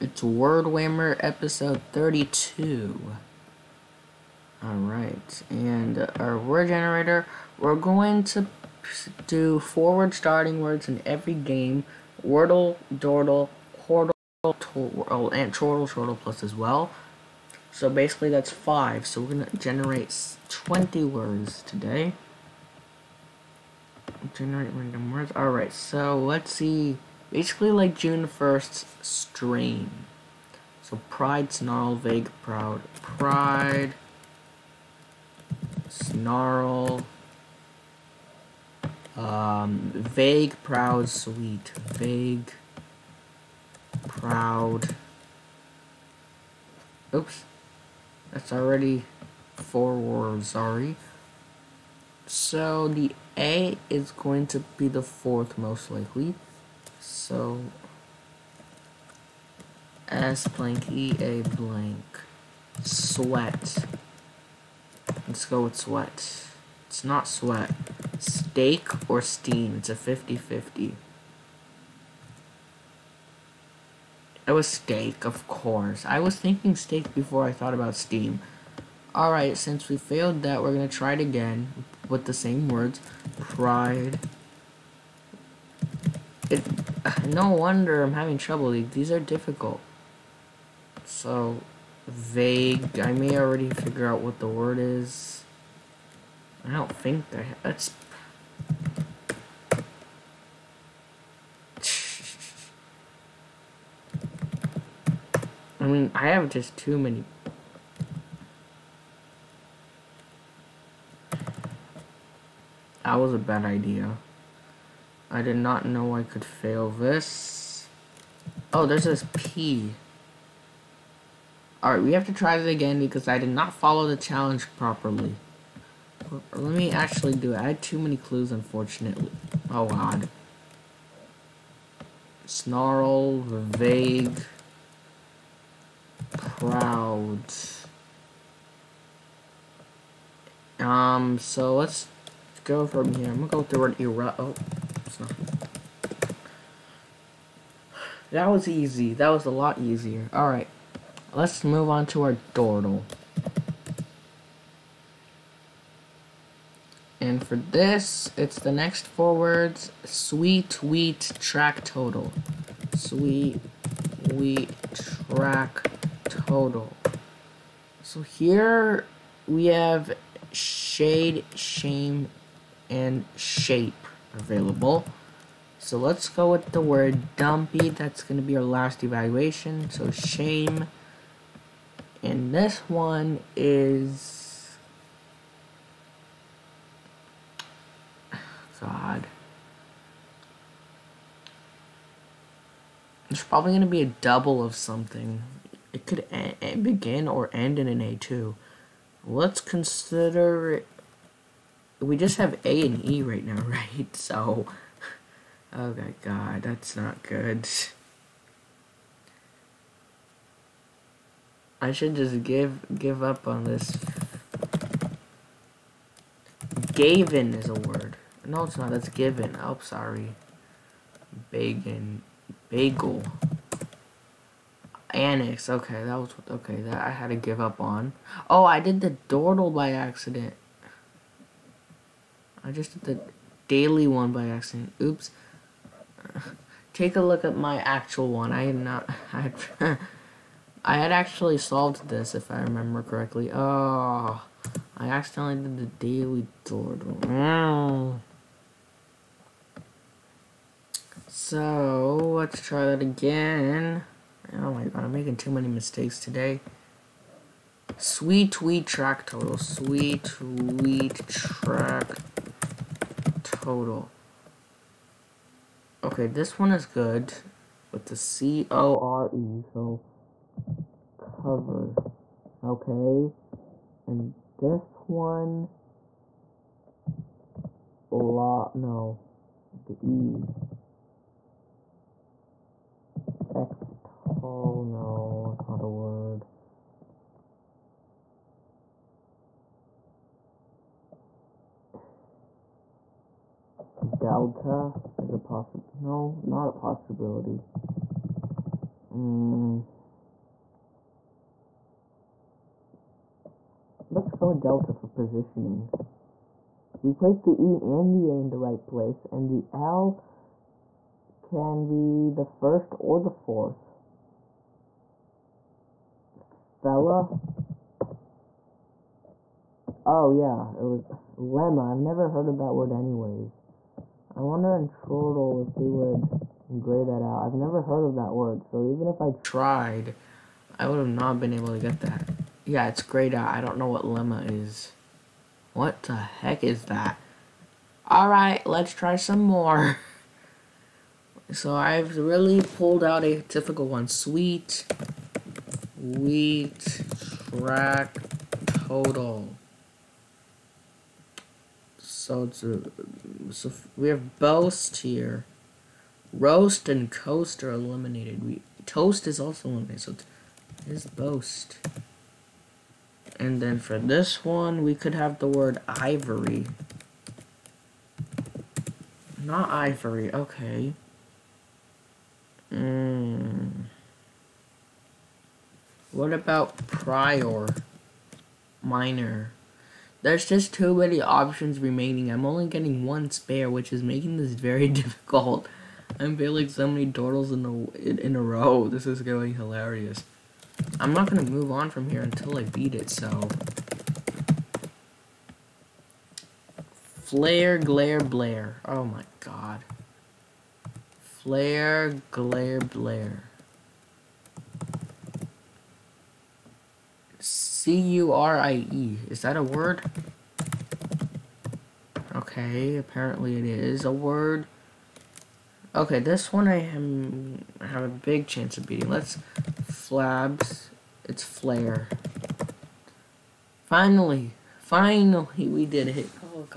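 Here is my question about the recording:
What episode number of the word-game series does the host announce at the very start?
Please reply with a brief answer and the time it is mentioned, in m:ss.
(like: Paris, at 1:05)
32, at 0:01.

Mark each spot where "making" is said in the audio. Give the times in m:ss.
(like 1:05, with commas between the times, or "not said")
4:15, 6:24.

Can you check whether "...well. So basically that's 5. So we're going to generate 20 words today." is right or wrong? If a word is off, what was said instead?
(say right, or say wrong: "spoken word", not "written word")
right.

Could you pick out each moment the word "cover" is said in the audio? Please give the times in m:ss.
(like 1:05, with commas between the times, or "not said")
4:31.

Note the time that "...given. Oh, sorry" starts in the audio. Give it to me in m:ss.
3:39.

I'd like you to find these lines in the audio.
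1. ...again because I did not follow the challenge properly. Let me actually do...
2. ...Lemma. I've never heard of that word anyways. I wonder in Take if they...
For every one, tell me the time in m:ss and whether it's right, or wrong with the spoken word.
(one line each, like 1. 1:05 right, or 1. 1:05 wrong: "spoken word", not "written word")
1. 2:02 right
2. 5:21 wrong: "Chortle", not "Take".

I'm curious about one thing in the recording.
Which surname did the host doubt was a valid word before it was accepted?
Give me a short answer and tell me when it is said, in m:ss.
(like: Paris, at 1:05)
Curie, at 6:47.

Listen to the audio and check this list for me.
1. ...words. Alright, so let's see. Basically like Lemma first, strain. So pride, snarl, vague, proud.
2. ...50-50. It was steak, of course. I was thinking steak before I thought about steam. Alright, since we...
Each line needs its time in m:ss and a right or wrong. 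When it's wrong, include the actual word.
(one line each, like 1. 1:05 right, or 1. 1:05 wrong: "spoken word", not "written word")
1. 0:25 wrong: "June", not "Lemma"
2. 1:09 right.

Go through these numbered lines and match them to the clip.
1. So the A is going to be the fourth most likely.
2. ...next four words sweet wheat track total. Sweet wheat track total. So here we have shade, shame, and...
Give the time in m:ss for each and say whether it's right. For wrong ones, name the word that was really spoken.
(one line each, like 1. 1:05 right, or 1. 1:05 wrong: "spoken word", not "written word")
1. 0:52 right
2. 2:38 right.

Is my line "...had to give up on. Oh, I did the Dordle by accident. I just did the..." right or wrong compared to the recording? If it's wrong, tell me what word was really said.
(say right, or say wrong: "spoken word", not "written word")
right.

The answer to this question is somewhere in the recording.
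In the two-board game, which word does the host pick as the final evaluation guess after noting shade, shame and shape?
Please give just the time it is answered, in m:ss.
2:57.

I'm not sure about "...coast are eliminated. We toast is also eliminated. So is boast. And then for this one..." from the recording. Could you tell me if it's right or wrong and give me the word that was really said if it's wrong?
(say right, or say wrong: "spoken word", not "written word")
right.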